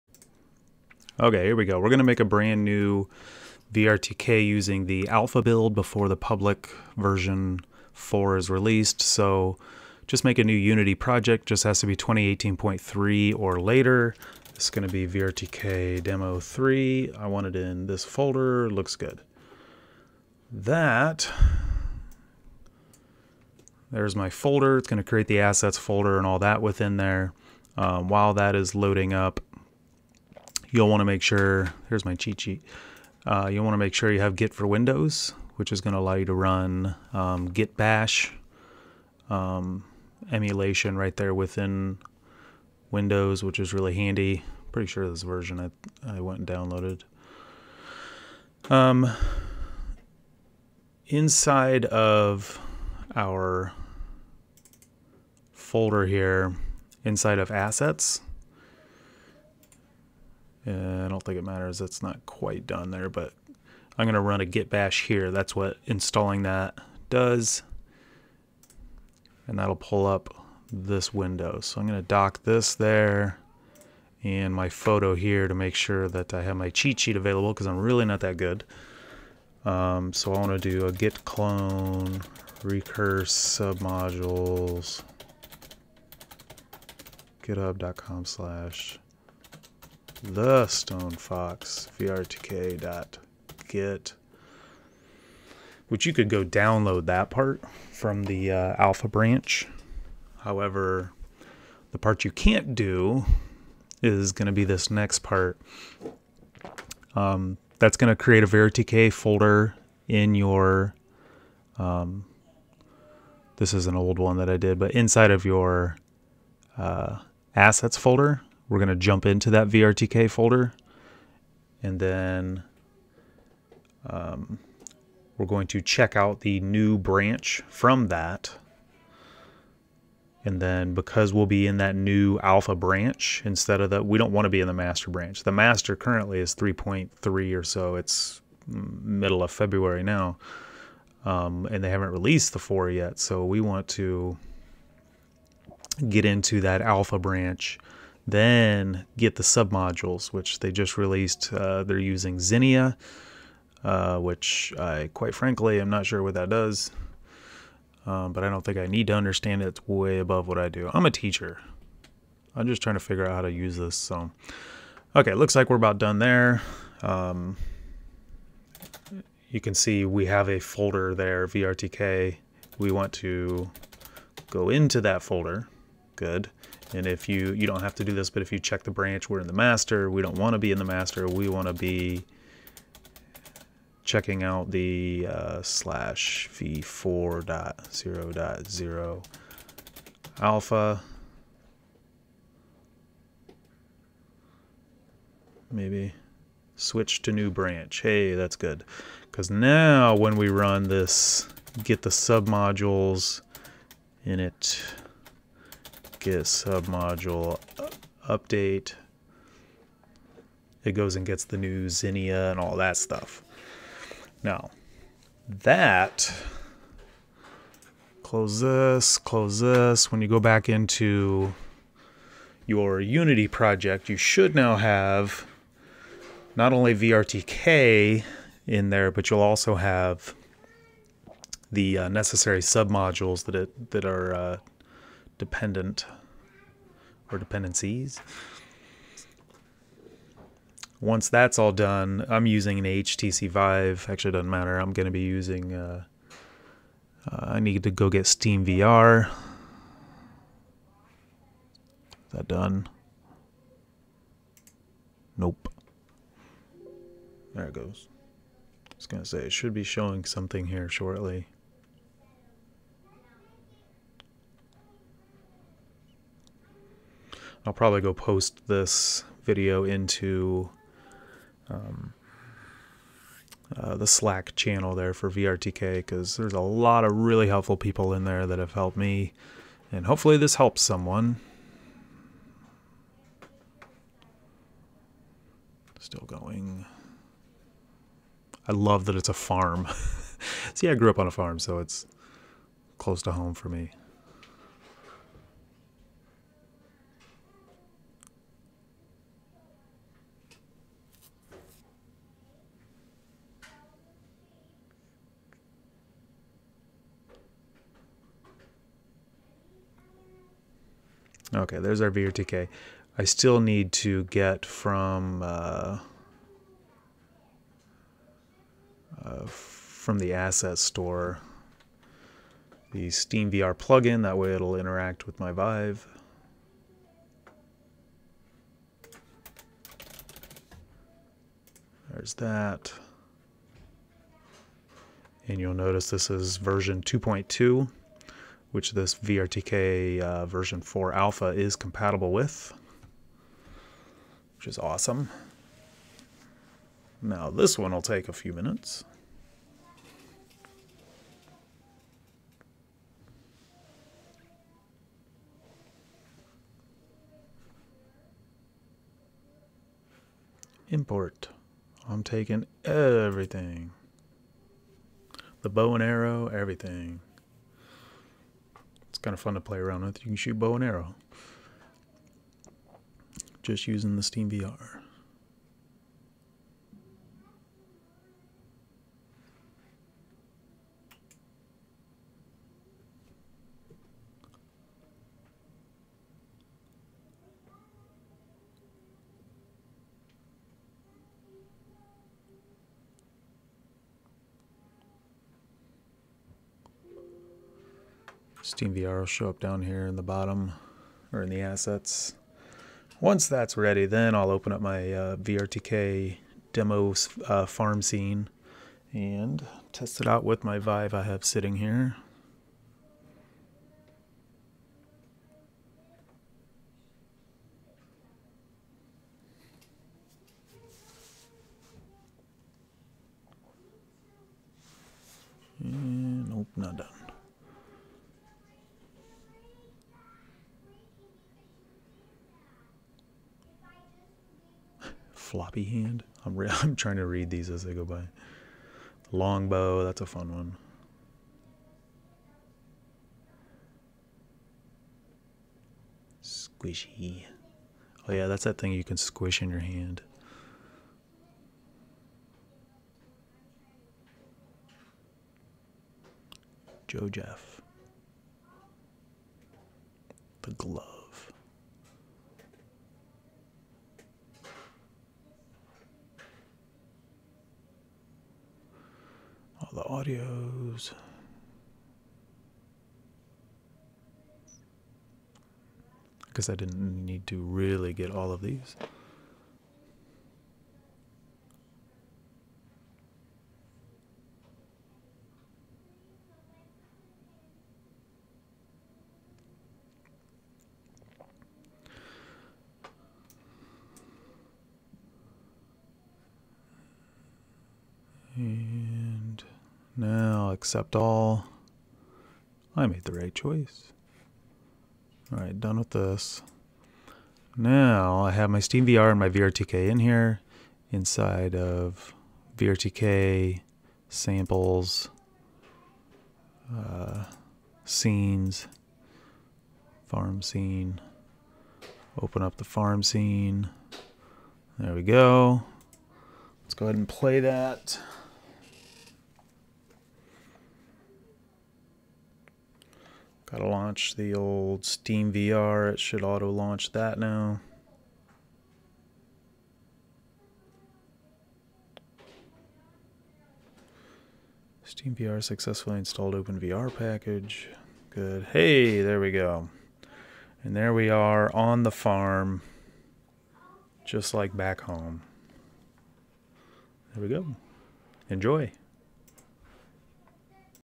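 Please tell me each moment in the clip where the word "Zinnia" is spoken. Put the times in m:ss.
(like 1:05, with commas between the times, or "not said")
2:32, 3:31.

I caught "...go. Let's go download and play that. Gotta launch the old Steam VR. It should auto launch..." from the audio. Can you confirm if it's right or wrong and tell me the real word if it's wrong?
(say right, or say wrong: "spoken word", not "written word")
wrong: "ahead", not "download".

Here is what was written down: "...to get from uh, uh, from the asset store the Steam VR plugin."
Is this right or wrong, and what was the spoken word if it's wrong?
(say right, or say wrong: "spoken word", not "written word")
right.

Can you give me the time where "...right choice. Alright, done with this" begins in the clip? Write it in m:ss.
8:23.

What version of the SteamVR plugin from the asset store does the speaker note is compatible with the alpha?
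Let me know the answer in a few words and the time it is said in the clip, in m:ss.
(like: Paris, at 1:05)
2.2, at 5:37.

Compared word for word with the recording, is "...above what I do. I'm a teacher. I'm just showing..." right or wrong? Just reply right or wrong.
wrong.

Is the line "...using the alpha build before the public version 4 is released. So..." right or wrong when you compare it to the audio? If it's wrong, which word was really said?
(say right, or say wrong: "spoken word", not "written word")
right.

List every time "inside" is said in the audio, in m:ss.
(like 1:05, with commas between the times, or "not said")
0:51, 0:57, 1:54, 8:31.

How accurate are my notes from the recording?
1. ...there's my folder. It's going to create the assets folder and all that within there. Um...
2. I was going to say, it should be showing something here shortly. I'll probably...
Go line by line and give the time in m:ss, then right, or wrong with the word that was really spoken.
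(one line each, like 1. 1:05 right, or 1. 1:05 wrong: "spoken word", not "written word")
1. 0:23 right
2. 4:18 right.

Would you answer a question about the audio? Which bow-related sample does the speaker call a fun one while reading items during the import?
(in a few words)
Longbow.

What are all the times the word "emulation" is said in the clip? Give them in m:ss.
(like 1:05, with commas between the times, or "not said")
0:40.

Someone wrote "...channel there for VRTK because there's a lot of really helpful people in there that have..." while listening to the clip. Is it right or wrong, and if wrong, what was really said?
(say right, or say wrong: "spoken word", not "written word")
right.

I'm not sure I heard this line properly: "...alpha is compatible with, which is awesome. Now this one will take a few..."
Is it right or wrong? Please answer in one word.
right.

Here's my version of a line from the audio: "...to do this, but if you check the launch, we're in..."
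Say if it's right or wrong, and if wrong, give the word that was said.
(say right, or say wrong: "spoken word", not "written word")
wrong: "branch", not "launch".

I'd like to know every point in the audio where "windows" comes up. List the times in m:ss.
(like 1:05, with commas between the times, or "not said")
0:34, 0:42, 1:11.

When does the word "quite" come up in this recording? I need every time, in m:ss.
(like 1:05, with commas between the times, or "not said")
1:02, 2:35.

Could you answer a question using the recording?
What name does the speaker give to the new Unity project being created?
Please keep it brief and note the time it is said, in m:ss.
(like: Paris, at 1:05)
VRTK demo 3, at 0:15.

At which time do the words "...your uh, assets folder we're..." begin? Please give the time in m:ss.
1:55.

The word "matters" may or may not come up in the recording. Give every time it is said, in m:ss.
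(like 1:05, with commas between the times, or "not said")
1:01, 4:04.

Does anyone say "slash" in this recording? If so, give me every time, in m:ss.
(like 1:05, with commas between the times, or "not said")
1:28, 3:05.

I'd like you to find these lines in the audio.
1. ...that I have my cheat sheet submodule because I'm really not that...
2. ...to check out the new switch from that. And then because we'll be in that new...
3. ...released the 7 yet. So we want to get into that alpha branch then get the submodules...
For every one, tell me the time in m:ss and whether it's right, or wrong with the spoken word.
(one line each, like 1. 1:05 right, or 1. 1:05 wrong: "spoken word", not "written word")
1. 1:16 wrong: "available", not "submodule"
2. 2:05 wrong: "branch", not "switch"
3. 2:22 wrong: "4", not "7".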